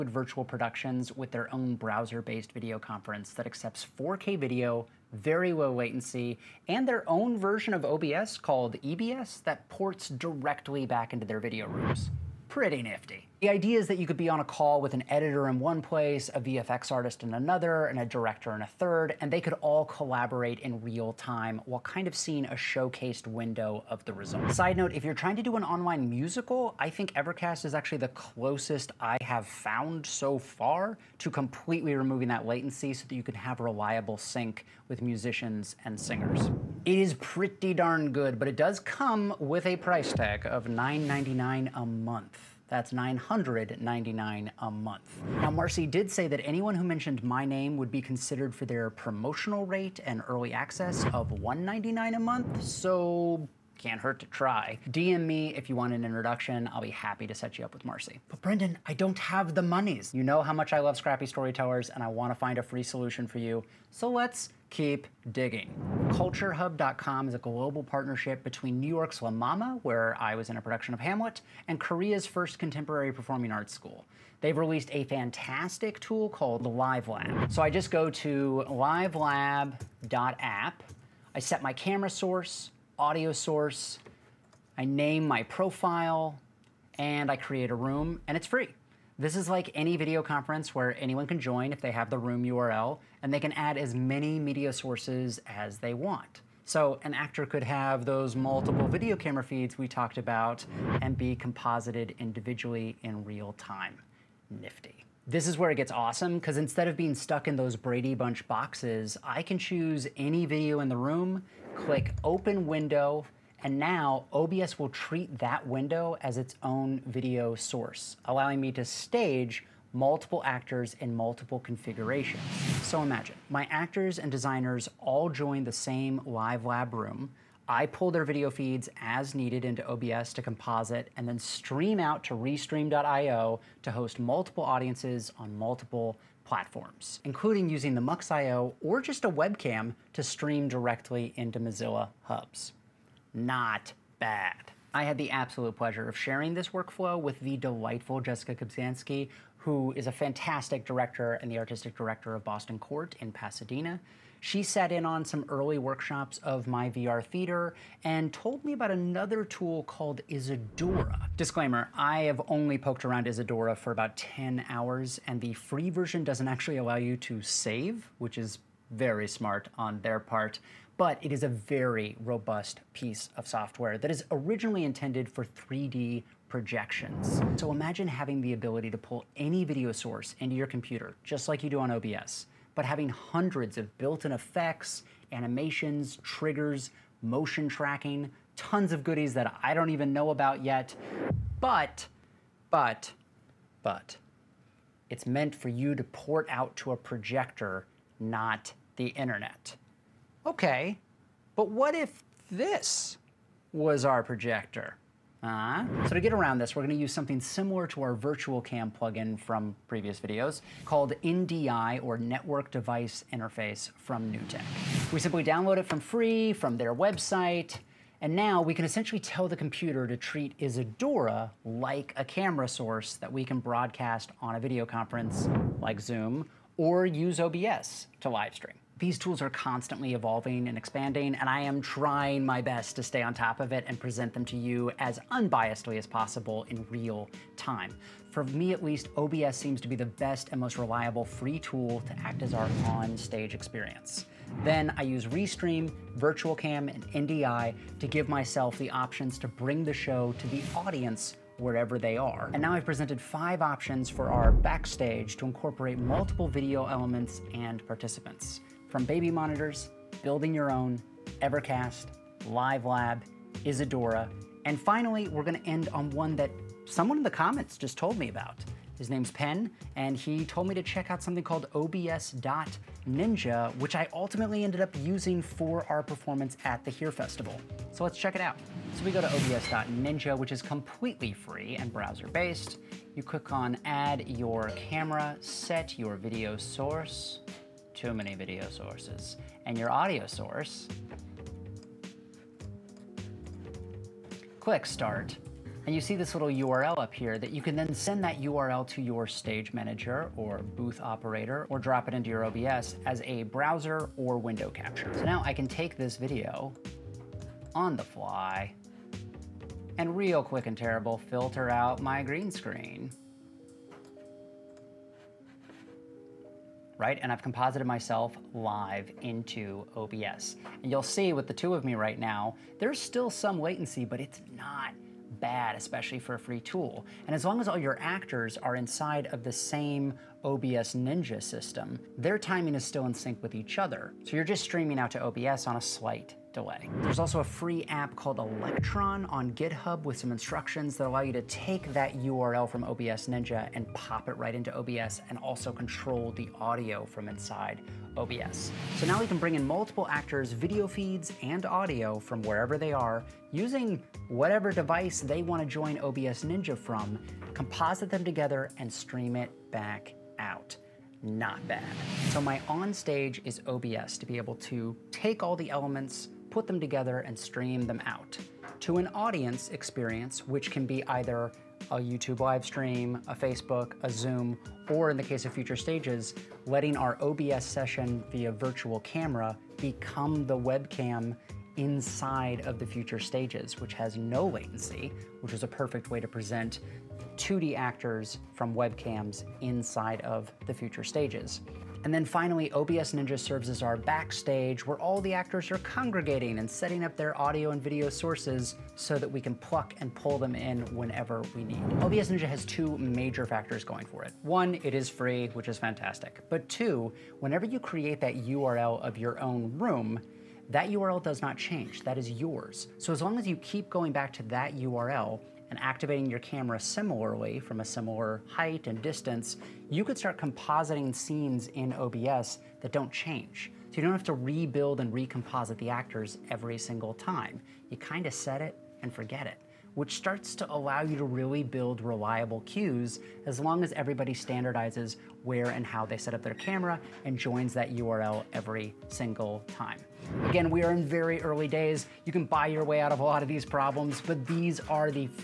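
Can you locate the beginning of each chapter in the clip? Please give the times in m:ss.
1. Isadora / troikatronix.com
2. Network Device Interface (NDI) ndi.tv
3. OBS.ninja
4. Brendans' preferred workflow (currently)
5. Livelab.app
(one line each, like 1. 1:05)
1. 2:39
2. 3:25
3. 4:28
4. 6:04
5. 1:05.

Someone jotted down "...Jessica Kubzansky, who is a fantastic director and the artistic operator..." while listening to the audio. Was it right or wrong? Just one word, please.
wrong.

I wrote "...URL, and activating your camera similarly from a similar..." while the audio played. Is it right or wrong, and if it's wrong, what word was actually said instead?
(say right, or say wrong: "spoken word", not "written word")
right.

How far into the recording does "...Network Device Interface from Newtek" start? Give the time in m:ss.
3:32.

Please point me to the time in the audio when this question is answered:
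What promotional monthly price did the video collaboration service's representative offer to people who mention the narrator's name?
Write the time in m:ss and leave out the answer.
0:51.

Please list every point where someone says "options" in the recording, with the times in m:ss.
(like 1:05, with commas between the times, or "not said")
4:08, 4:13.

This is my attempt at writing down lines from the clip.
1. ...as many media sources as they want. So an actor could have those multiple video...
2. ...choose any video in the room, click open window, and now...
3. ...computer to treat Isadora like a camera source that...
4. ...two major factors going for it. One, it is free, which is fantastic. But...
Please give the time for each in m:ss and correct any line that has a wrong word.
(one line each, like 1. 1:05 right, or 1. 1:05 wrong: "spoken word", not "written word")
1. 1:33 right
2. 1:49 right
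3. 3:39 right
4. 6:42 right.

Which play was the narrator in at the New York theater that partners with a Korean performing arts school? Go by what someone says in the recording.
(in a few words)
Hamlet.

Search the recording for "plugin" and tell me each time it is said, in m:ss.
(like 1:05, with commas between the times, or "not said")
3:28.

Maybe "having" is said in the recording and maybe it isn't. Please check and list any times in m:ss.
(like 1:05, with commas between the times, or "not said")
2:58, 3:02.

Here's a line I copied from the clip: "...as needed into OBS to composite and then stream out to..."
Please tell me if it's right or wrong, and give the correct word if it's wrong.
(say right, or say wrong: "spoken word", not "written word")
right.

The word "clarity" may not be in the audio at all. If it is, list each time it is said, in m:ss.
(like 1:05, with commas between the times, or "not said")
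not said.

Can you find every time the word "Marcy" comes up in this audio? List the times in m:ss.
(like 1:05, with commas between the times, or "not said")
0:45, 0:57.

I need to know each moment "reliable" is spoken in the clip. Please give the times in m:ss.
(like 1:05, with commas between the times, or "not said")
0:33, 4:00, 7:12.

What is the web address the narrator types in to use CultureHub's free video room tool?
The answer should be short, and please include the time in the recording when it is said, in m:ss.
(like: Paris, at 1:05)
livelab.app, at 1:18.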